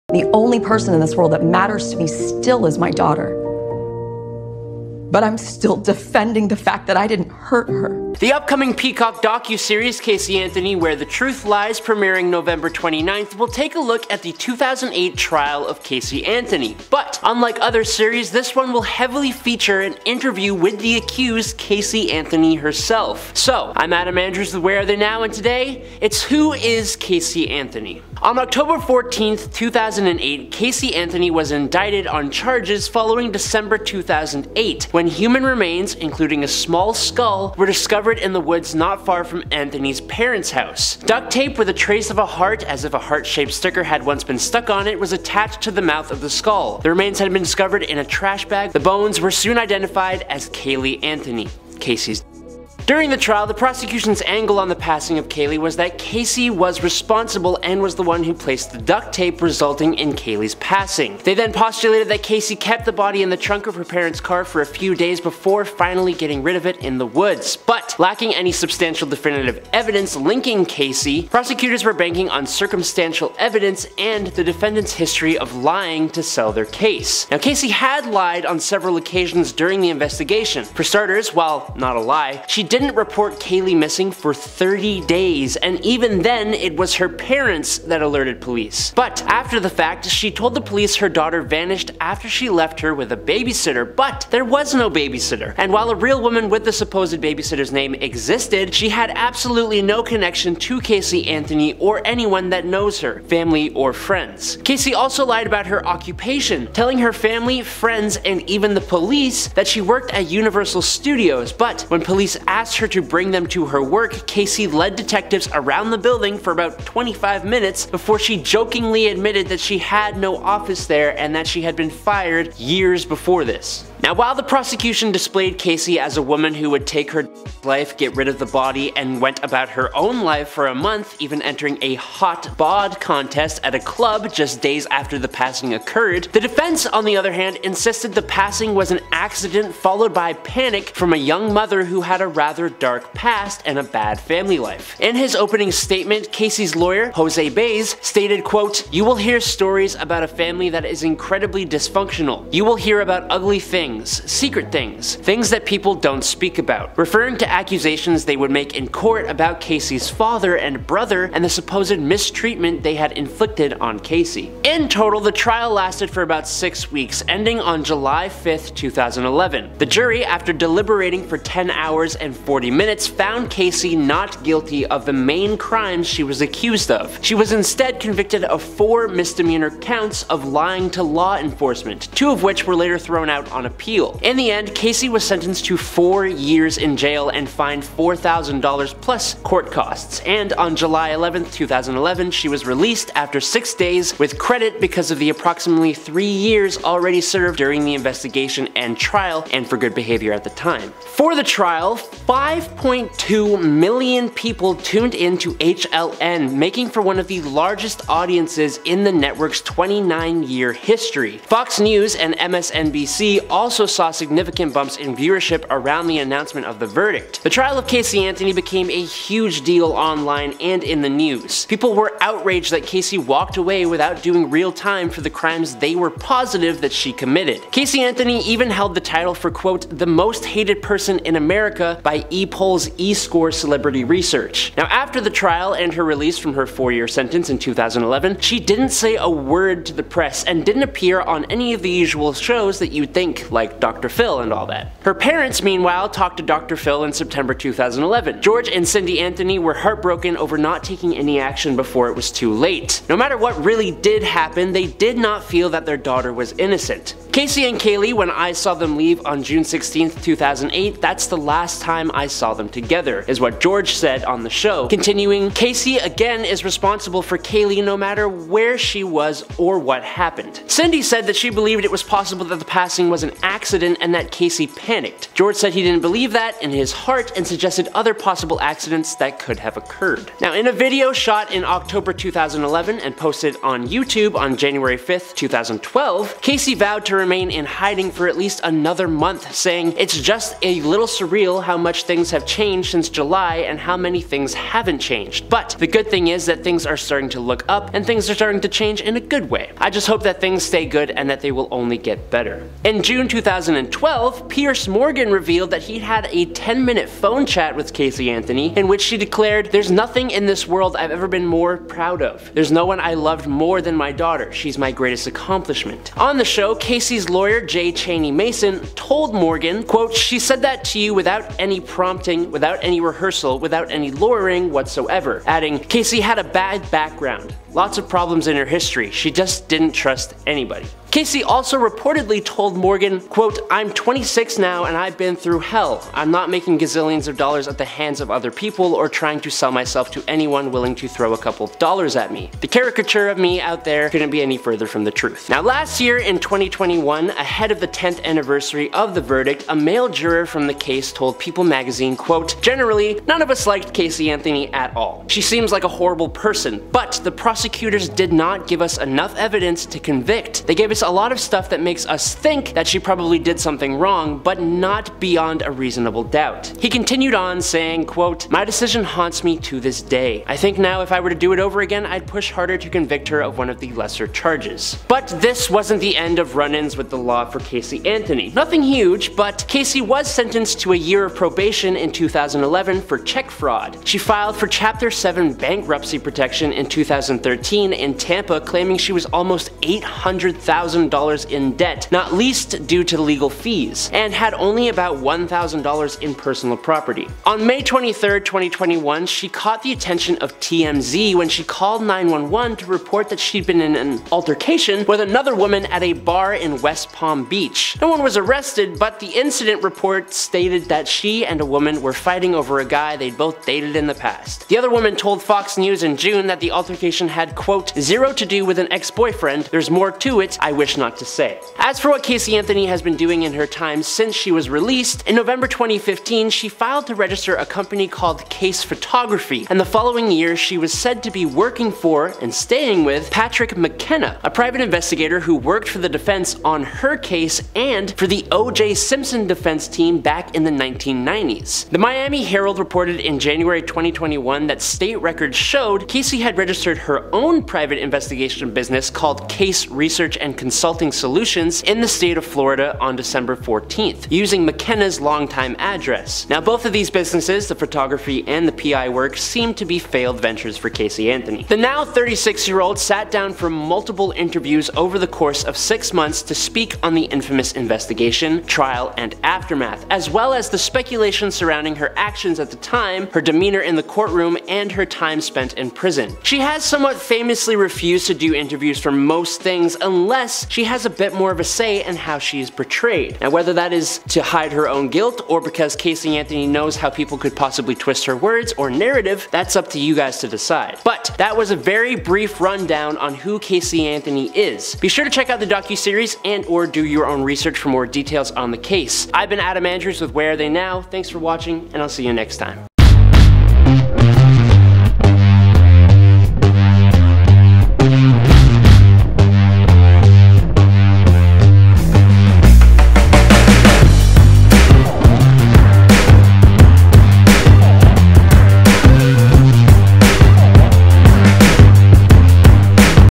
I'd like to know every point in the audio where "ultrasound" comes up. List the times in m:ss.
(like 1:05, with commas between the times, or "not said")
not said.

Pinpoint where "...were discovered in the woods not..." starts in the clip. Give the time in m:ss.
0:37.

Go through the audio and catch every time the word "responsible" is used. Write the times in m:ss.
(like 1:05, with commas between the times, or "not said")
0:56, 4:26.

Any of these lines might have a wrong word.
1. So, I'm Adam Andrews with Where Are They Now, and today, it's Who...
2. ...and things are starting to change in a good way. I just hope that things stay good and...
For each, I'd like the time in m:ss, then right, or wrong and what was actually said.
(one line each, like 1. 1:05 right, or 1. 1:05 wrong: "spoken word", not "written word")
1. 0:23 right
2. 4:57 right.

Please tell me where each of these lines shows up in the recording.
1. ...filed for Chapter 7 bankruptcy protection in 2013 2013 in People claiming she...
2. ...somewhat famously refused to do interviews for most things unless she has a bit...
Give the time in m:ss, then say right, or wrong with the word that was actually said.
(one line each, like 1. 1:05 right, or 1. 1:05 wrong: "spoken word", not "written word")
1. 6:24 wrong: "Tampa", not "People"
2. 7:56 right.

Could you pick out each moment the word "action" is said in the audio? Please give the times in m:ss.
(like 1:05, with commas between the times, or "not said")
4:11, 7:52.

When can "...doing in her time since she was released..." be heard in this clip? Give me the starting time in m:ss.
7:03.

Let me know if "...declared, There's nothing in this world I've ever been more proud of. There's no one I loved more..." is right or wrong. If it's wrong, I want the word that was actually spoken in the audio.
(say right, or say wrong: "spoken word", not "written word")
right.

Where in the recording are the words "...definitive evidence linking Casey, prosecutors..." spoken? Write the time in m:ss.
1:09.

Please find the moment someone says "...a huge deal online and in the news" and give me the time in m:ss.
3:38.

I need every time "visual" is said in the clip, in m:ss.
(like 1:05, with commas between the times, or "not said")
not said.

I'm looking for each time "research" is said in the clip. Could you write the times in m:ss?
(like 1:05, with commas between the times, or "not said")
3:54, 7:29, 8:17.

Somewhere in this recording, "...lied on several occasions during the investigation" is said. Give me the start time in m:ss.
1:18.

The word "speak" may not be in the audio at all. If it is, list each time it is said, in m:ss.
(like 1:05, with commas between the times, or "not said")
2:36, 7:46.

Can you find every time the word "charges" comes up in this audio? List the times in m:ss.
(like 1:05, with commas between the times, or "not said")
0:32, 6:14.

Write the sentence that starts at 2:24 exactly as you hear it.
In his opening statement, Casey's lawyer, Jose Baez, stated, quote, You will hear stories about a family that is incredibly dysfunctional.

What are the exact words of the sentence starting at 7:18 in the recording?
Simpson defense team back in the 1990s.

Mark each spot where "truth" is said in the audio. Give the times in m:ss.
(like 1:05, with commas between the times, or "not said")
0:11, 5:45.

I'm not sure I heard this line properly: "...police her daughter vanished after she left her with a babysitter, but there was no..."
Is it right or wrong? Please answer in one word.
right.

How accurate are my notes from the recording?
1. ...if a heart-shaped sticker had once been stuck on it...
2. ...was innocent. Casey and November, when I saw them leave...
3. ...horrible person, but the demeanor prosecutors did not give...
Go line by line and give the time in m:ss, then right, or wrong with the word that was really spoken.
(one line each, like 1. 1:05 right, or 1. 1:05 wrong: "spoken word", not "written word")
1. 0:42 right
2. 4:16 wrong: "Caylee", not "November"
3. 5:55 wrong: "prosecutor", not "demeanor".